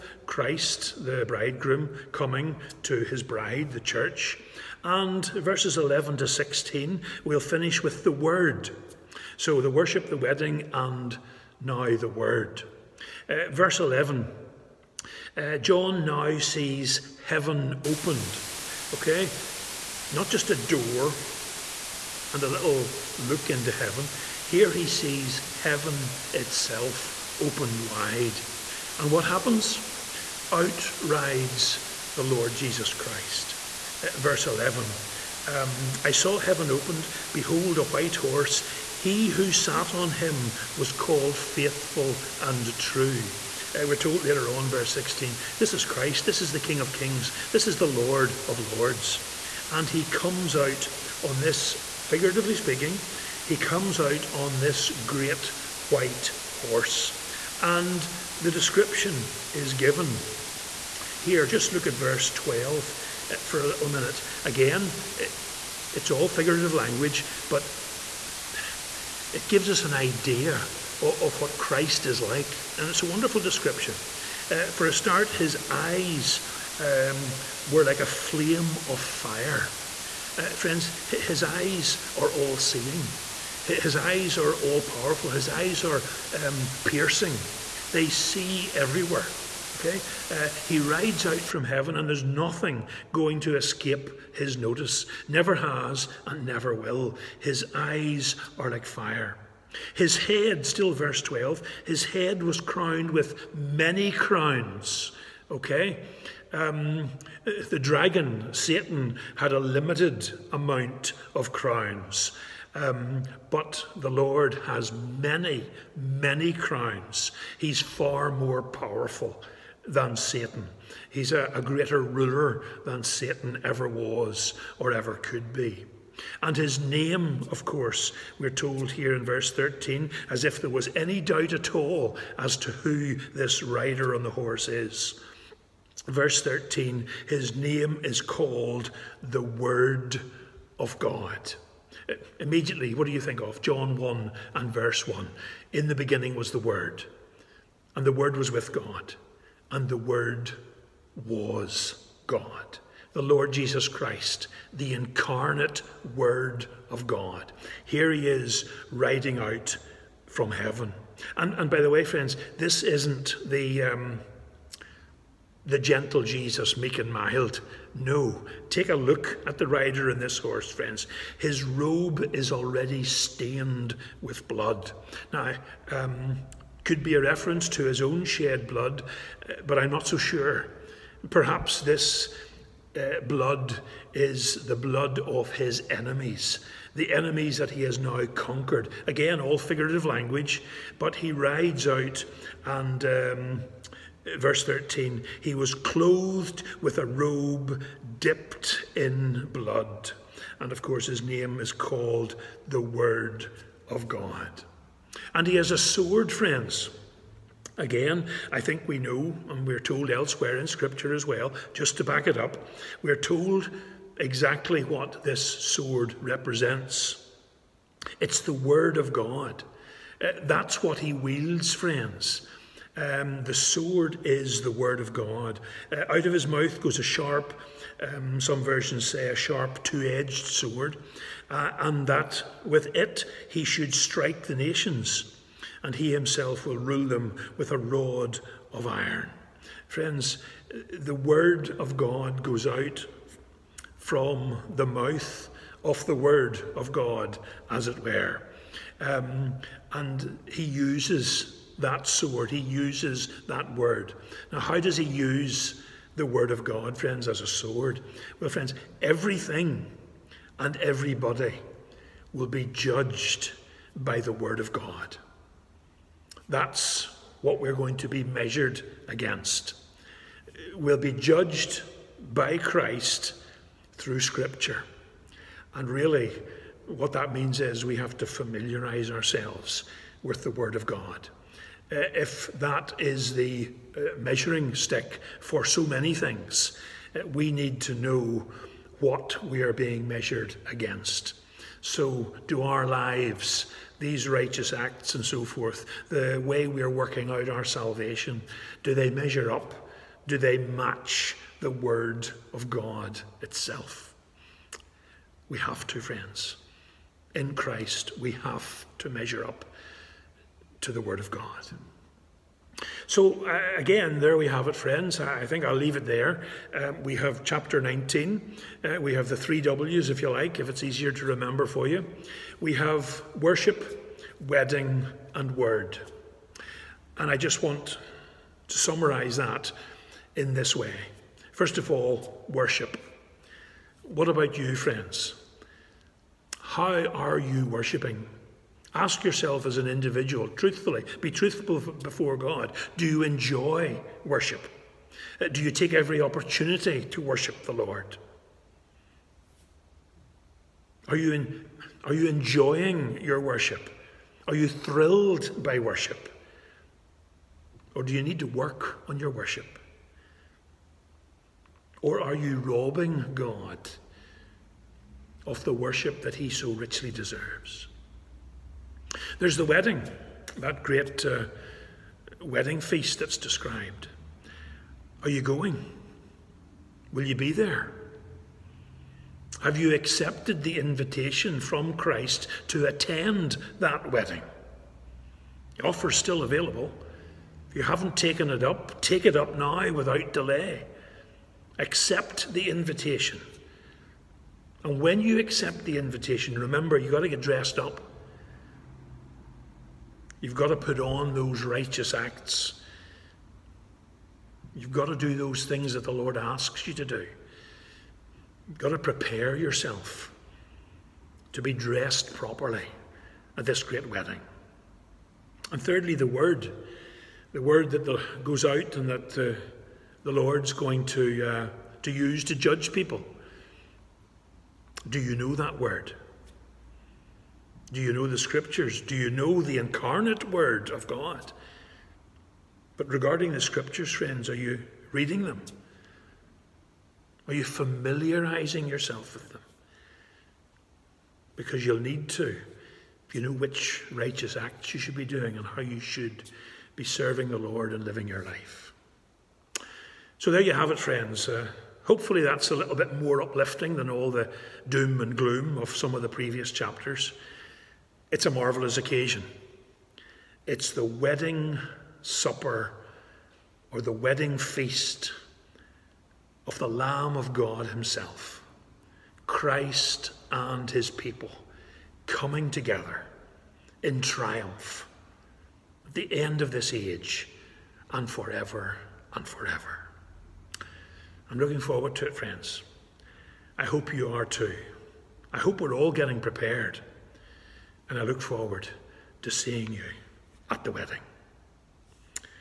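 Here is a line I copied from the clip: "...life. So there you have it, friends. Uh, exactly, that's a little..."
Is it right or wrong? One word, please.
wrong.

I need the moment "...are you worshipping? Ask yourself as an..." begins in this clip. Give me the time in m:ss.
5:37.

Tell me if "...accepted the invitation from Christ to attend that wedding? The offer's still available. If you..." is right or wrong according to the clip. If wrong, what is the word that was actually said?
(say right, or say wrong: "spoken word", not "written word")
right.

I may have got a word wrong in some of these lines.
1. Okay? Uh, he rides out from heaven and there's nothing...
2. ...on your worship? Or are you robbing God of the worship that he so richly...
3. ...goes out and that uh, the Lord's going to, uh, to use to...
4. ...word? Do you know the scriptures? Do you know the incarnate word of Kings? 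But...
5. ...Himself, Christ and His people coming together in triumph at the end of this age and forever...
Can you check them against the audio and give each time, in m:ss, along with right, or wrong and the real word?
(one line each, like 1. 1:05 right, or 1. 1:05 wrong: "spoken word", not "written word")
1. 1:29 right
2. 5:59 right
3. 6:58 right
4. 7:05 wrong: "God", not "Kings"
5. 7:47 right.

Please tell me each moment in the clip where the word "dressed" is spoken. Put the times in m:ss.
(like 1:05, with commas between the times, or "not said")
6:37, 6:51.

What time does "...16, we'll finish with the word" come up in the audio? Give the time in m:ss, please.
0:06.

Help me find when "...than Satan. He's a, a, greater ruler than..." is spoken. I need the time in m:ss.
1:59.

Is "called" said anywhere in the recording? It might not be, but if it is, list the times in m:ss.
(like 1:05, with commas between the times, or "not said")
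0:40, 2:18, 3:21.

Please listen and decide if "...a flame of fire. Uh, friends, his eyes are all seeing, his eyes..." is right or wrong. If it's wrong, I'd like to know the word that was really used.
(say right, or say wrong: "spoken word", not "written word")
right.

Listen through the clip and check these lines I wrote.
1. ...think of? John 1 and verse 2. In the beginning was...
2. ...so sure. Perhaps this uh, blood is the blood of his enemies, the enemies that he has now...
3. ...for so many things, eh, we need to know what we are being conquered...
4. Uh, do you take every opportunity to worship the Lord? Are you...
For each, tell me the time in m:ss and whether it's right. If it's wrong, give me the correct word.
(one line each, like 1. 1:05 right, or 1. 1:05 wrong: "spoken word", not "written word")
1. 2:23 wrong: "1", not "2"
2. 3:00 right
3. 4:45 wrong: "measured", not "conquered"
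4. 5:45 right.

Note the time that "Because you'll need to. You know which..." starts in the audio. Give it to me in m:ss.
7:21.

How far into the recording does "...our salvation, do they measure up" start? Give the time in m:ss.
4:57.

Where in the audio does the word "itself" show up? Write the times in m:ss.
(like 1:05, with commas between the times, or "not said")
0:26, 5:03.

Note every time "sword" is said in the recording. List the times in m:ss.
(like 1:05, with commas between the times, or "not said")
3:25, 3:35, 3:43, 3:50, 4:12, 4:17.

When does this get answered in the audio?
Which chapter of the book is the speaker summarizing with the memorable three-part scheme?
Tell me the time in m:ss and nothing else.
5:17.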